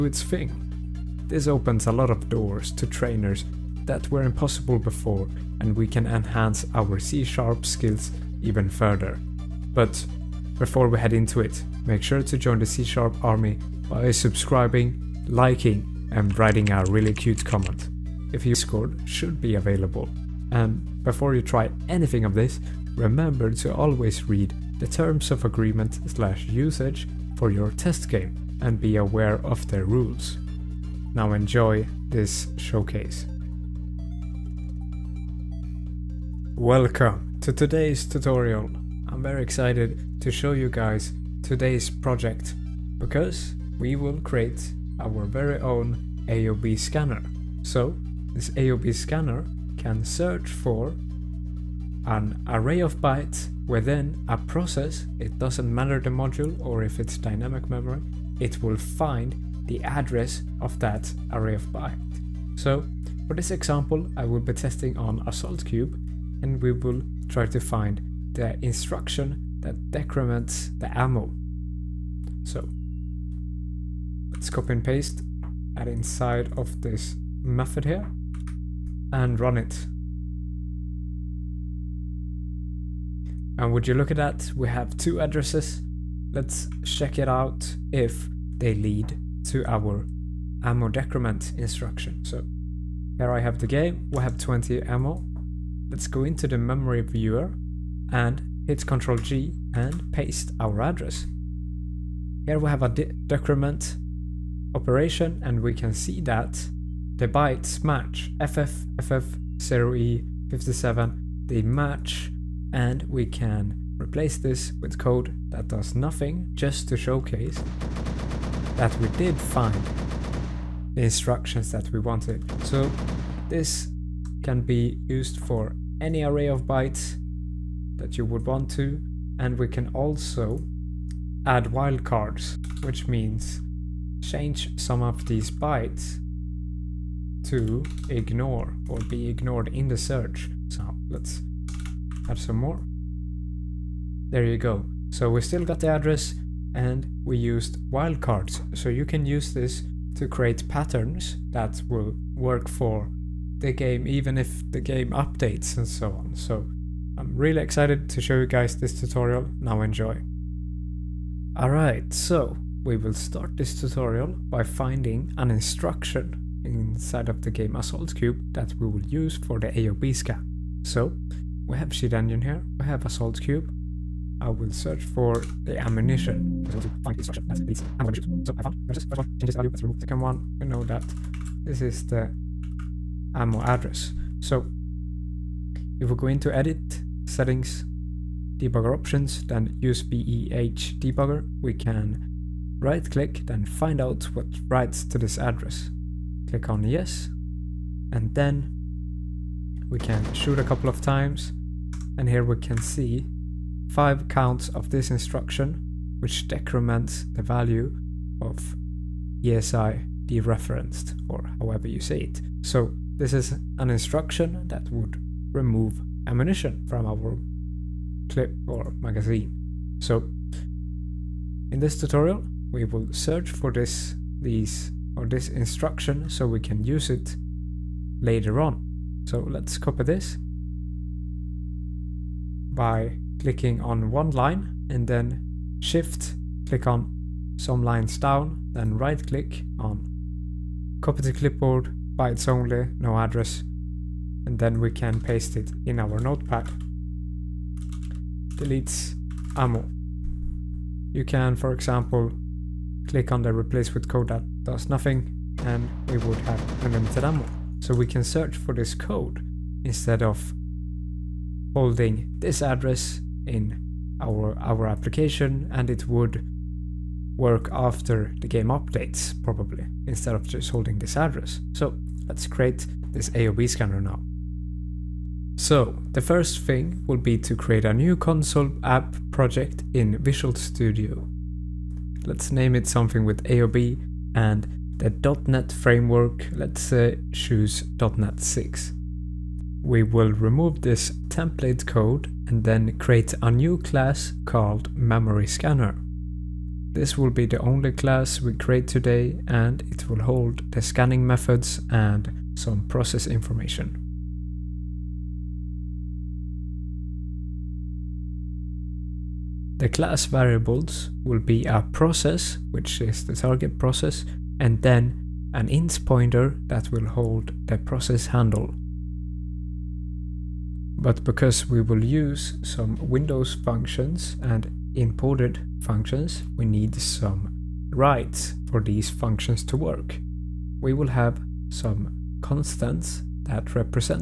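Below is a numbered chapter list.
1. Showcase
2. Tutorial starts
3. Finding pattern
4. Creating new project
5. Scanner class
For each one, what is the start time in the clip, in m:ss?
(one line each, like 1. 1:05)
1. 0:46
2. 2:54
3. 3:15
4. 4:46
5. 5:04.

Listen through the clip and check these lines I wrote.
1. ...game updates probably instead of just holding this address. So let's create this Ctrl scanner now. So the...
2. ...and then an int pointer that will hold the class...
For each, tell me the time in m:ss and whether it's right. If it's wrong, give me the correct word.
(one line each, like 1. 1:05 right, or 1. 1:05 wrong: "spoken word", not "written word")
1. 4:28 wrong: "AOB", not "Ctrl"
2. 5:14 wrong: "process", not "class".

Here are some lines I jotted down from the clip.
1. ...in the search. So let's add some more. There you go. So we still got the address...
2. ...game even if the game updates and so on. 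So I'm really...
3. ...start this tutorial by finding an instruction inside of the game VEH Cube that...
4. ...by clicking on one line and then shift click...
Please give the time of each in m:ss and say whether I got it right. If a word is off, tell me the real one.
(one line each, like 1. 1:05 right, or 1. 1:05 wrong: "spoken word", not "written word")
1. 2:19 right
2. 2:33 right
3. 2:43 wrong: "Assault", not "VEH"
4. 3:52 right.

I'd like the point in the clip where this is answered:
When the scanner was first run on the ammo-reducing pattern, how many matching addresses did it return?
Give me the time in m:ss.
1:24.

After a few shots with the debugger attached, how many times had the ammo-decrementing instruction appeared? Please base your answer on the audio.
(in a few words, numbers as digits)
5.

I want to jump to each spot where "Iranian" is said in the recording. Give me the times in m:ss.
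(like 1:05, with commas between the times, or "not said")
not said.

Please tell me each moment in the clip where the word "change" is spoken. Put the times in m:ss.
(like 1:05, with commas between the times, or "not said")
2:14.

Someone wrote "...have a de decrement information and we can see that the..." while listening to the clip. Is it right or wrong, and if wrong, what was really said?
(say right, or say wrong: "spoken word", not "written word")
wrong: "operation", not "information".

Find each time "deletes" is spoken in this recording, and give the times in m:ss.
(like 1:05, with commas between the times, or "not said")
4:08.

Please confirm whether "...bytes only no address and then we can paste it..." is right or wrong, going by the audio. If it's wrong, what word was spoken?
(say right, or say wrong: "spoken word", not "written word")
right.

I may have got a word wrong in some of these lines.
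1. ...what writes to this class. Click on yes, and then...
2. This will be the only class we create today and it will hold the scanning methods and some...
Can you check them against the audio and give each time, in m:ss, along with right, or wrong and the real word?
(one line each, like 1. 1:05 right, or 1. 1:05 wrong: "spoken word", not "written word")
1. 3:14 wrong: "address", not "class"
2. 4:56 right.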